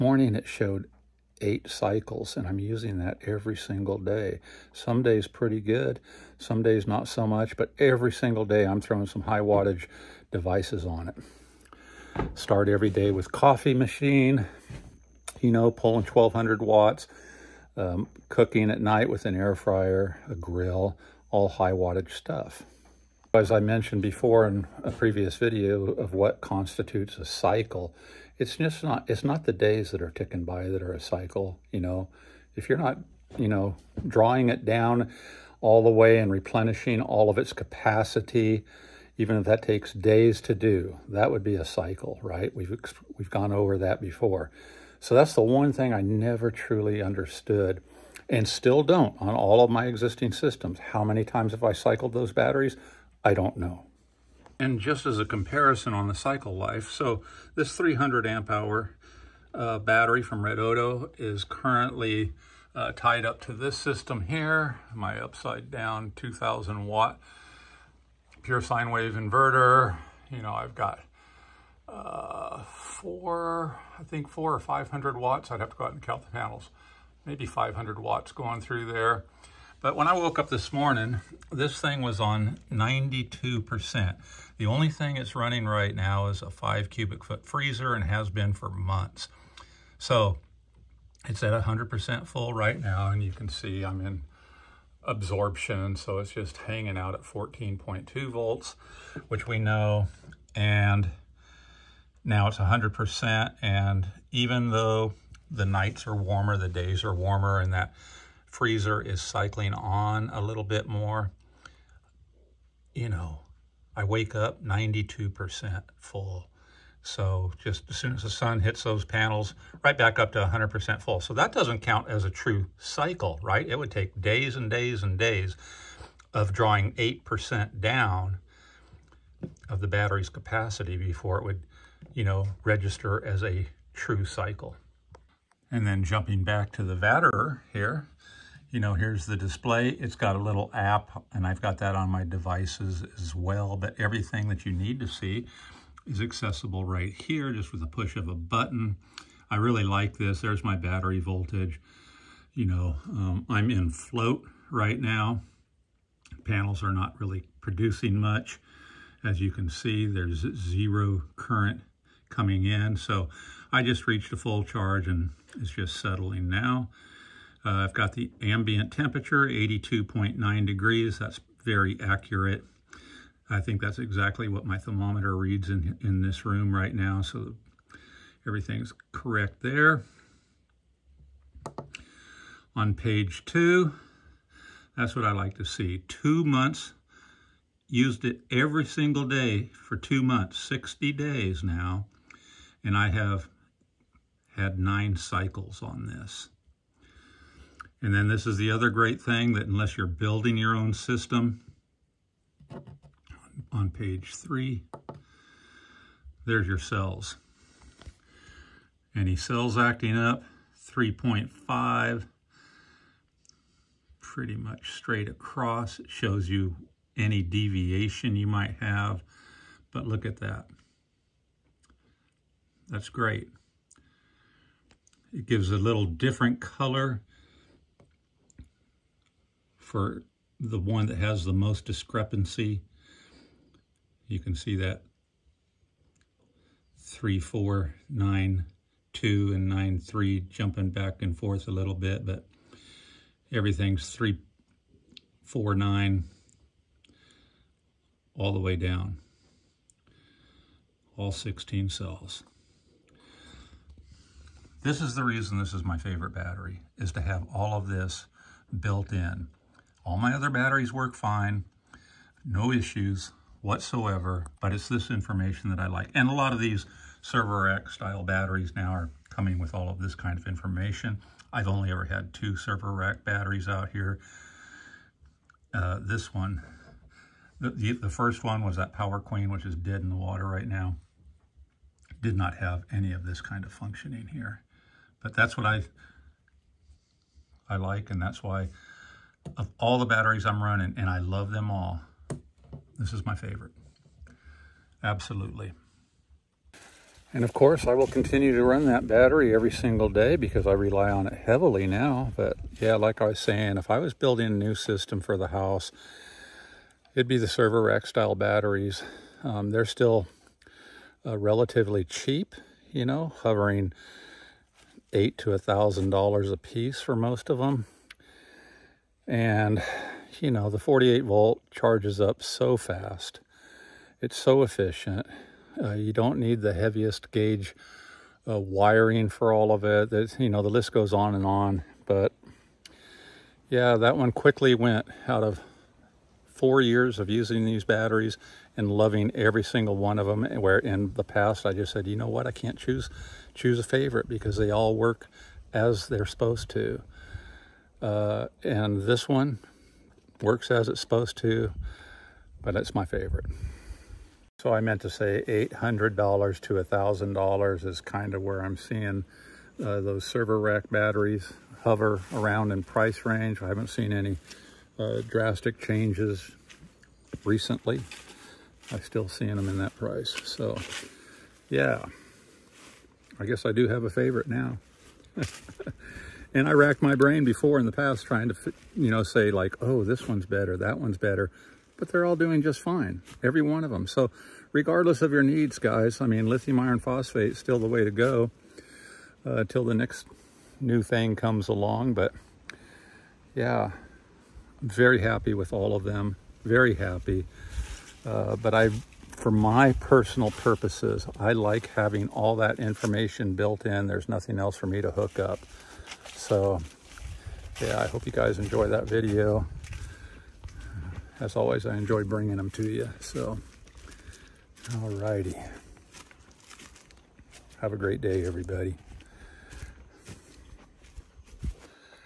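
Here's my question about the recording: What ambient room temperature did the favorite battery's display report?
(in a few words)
82.9 degrees.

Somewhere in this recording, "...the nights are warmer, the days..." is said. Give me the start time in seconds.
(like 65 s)
105 s.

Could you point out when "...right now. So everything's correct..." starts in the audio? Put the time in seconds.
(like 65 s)
176 s.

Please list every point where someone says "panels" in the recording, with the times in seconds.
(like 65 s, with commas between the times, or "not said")
76 s, 119 s, 156 s.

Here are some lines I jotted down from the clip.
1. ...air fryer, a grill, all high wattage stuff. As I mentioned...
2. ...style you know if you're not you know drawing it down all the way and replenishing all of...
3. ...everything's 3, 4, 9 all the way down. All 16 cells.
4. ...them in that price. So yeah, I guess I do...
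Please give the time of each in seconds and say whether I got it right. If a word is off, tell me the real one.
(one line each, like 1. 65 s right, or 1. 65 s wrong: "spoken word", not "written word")
1. 19 s right
2. 30 s wrong: "cycle", not "style"
3. 243 s right
4. 369 s right.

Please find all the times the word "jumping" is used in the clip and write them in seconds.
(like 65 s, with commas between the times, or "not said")
136 s, 240 s.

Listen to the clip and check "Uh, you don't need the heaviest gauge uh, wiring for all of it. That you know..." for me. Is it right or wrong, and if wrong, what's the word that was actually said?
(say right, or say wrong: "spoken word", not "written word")
right.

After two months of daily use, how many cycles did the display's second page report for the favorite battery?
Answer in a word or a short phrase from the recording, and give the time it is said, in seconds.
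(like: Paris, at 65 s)
9, at 194 s.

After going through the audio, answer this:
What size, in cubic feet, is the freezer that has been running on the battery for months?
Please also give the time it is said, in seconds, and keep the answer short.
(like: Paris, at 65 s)
5 cubic feet, at 86 s.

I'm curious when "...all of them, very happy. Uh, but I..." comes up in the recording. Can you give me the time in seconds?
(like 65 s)
395 s.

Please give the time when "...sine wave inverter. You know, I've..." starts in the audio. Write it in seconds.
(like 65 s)
68 s.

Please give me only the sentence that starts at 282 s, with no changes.
Did not have any of this kind of functioning here.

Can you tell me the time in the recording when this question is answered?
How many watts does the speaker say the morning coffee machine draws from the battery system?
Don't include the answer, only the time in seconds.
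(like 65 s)
16 s.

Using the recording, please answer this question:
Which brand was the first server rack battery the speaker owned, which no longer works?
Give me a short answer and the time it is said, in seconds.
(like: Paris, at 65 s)
Power Queen, at 278 s.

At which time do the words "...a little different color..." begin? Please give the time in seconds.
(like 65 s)
225 s.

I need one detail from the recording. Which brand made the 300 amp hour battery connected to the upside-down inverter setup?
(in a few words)
Redodo.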